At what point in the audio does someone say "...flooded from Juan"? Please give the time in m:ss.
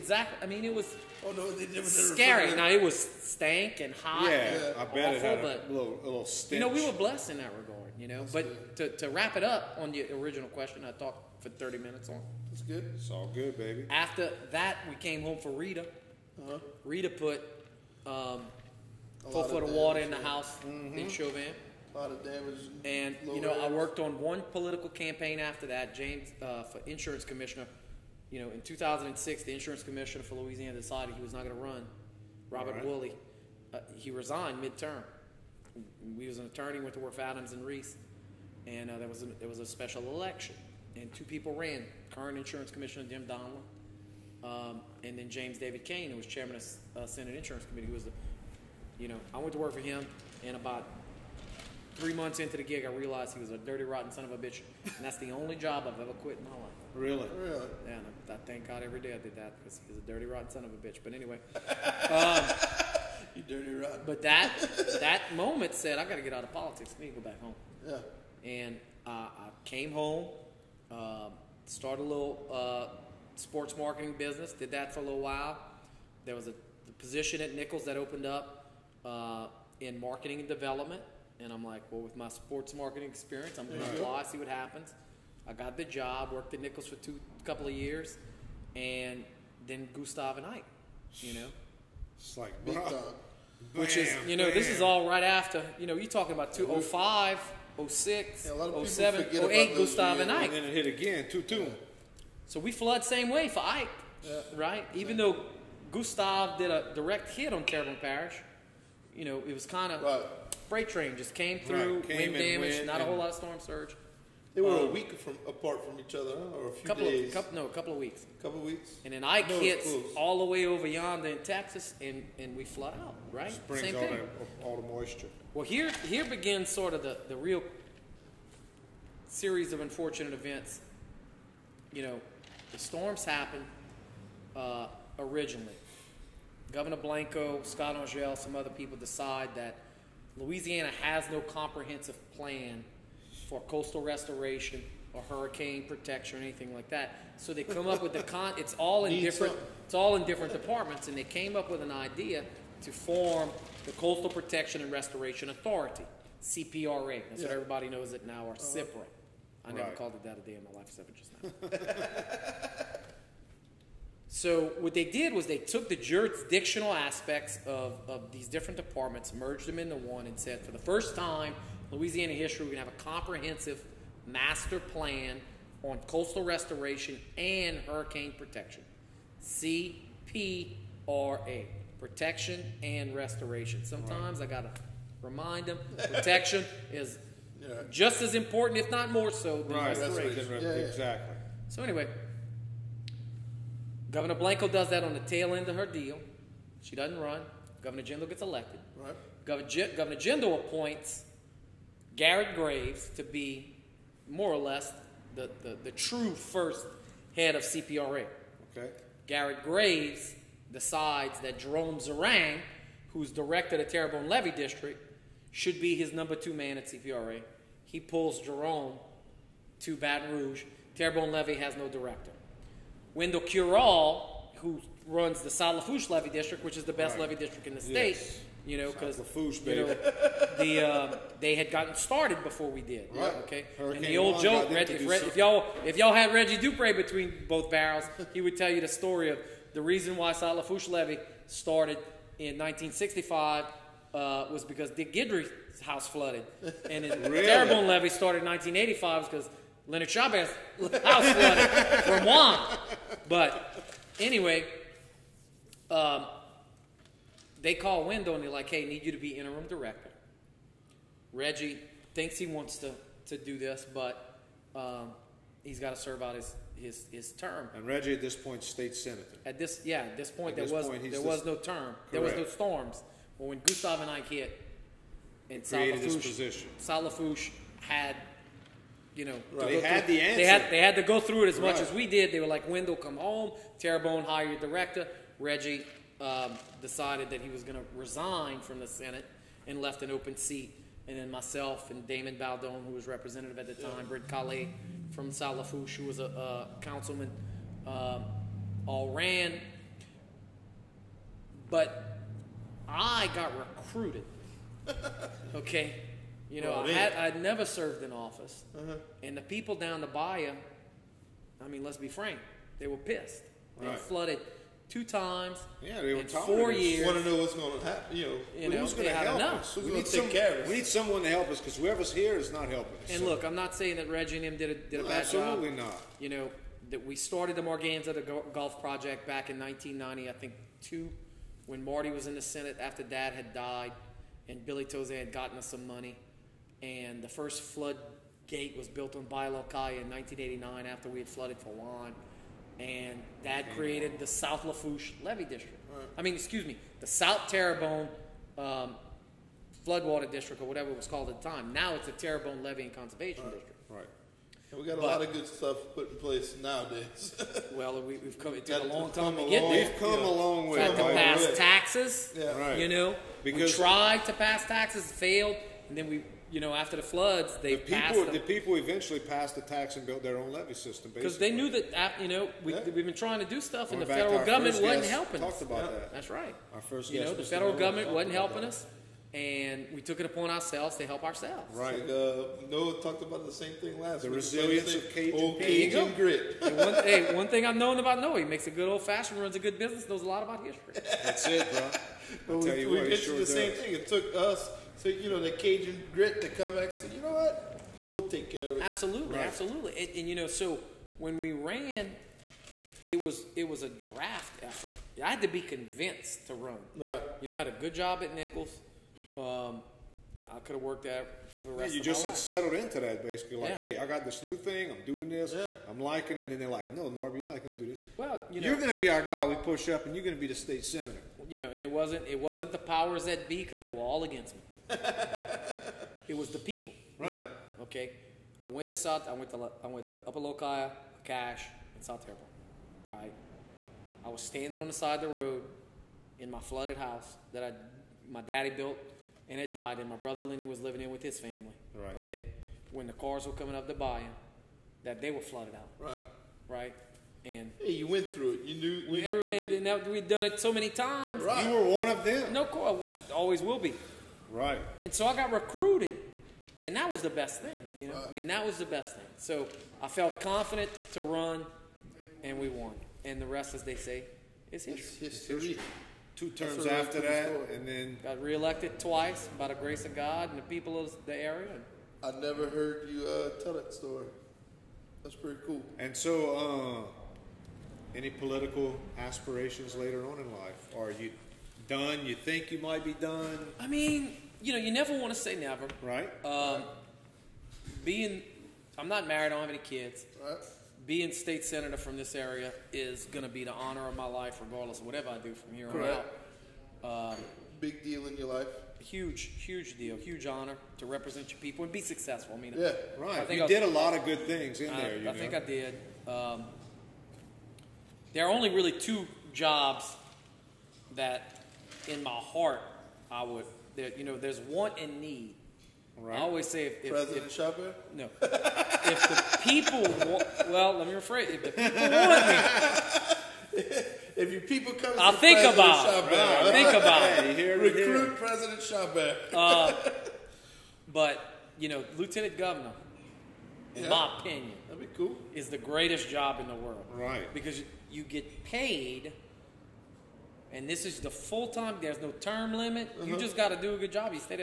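4:11.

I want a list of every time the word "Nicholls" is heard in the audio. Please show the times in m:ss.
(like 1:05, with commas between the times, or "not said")
1:17, 1:26, 6:48.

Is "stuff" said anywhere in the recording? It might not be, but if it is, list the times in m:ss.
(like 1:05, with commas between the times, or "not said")
5:55, 6:13.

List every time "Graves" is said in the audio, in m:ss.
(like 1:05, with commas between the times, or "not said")
3:22, 3:29.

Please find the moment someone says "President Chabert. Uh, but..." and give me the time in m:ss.
8:48.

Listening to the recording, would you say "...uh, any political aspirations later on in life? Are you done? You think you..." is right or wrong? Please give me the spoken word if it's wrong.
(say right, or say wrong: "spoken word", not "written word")
right.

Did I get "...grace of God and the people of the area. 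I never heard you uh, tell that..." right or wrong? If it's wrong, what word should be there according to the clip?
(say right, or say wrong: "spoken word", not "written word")
right.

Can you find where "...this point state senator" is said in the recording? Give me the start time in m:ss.
4:28.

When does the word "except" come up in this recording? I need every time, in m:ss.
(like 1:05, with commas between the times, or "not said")
2:40.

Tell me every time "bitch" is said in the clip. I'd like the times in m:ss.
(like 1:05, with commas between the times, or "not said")
0:54, 1:00.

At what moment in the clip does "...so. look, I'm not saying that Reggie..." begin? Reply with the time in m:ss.
5:23.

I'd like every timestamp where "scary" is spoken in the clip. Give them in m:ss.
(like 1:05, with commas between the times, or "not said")
0:02.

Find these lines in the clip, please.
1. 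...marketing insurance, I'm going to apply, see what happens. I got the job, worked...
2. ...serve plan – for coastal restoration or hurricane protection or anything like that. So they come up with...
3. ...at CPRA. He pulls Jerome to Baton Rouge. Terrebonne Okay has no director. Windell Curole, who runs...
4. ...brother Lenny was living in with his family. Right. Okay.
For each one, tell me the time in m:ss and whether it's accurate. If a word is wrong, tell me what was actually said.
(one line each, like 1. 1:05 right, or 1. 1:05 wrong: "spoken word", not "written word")
1. 1:22 wrong: "experience", not "insurance"
2. 2:21 wrong: "comprehensive", not "serve"
3. 3:36 wrong: "Levee", not "Okay"
4. 7:20 right.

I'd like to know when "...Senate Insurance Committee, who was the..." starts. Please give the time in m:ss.
0:47.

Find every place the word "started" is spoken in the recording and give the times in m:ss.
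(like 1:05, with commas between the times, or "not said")
1:11, 3:51, 4:01, 4:08, 5:27.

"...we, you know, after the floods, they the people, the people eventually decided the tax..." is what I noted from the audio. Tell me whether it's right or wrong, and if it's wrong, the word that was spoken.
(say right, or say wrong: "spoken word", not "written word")
wrong: "passed", not "decided".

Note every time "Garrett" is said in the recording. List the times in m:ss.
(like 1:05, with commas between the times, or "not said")
3:22, 3:29.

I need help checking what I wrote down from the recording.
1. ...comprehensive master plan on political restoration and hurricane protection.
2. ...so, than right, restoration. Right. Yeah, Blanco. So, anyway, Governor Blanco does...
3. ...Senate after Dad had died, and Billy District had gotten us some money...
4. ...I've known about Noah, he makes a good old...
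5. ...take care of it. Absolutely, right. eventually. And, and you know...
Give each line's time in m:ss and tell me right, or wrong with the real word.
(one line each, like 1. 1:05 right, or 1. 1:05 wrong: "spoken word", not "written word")
1. 2:53 wrong: "coastal", not "political"
2. 3:09 wrong: "Exactly", not "Blanco"
3. 5:32 wrong: "Tauzin", not "District"
4. 6:27 right
5. 6:38 wrong: "absolutely", not "eventually".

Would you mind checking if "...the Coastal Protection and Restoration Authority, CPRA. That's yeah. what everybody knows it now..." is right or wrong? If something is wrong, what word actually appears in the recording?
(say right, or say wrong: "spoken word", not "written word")
right.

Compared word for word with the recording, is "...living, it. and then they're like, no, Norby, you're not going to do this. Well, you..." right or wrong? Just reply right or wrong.
wrong.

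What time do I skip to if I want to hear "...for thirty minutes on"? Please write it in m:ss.
0:11.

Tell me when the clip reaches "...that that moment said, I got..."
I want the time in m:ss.
1:04.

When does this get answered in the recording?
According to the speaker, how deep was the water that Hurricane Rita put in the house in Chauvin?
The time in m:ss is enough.
0:19.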